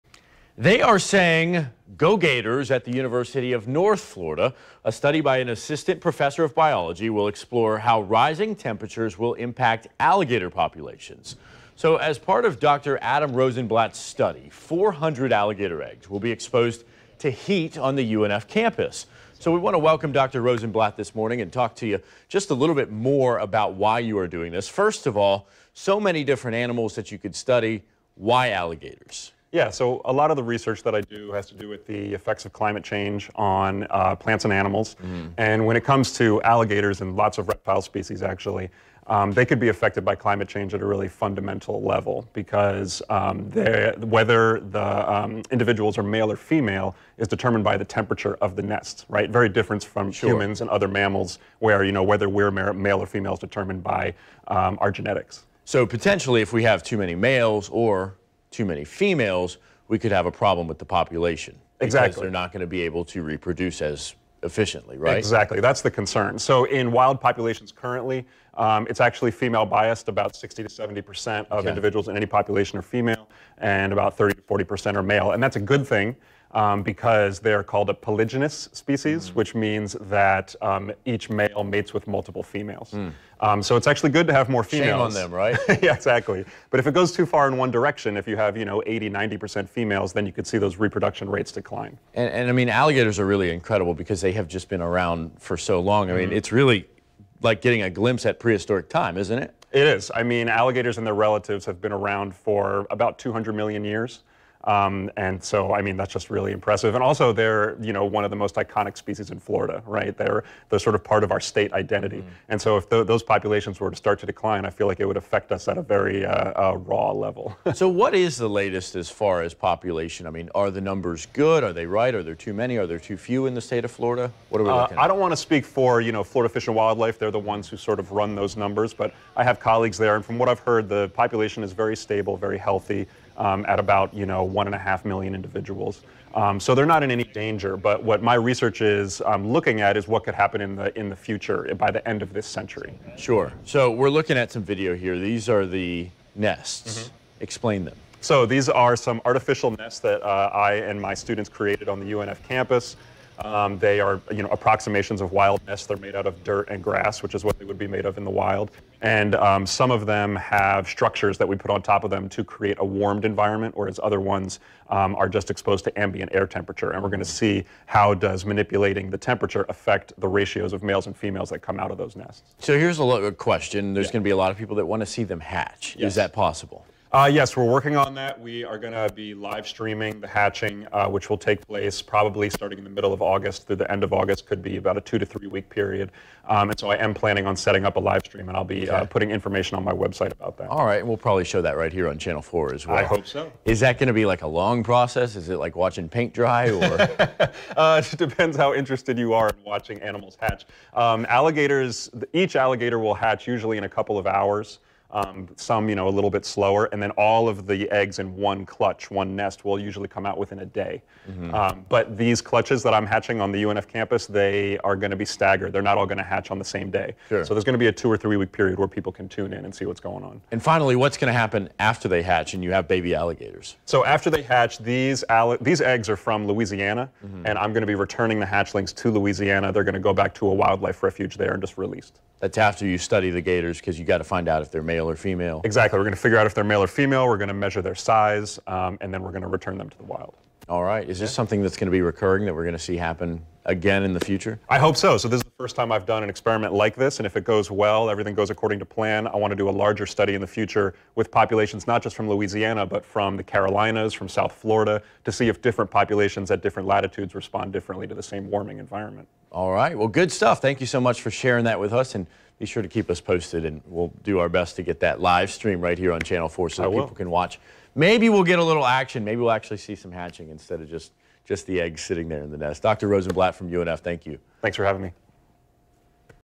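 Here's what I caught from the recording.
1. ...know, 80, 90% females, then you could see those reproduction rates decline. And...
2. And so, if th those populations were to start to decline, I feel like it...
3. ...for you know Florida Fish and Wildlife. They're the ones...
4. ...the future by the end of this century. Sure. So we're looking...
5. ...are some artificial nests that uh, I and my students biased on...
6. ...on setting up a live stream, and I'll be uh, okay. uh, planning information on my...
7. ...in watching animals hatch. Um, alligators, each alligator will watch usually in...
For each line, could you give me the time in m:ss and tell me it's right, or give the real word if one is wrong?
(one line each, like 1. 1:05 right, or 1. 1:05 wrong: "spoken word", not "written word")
1. 1:28 right
2. 1:52 right
3. 2:05 right
4. 2:21 right
5. 2:28 wrong: "created", not "biased"
6. 3:07 wrong: "putting", not "planning"
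7. 3:19 wrong: "hatch", not "watch".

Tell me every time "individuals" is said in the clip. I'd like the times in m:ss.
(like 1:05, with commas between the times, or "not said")
0:45, 1:11, 2:15.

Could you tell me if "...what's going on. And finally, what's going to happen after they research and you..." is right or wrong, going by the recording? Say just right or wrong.
wrong.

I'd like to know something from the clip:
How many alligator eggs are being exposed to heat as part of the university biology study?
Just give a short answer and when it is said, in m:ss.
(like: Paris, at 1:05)
400, at 0:14.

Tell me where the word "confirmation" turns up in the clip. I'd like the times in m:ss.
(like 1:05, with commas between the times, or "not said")
not said.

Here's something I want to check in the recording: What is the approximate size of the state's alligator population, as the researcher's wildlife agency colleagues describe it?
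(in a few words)
1.5 million.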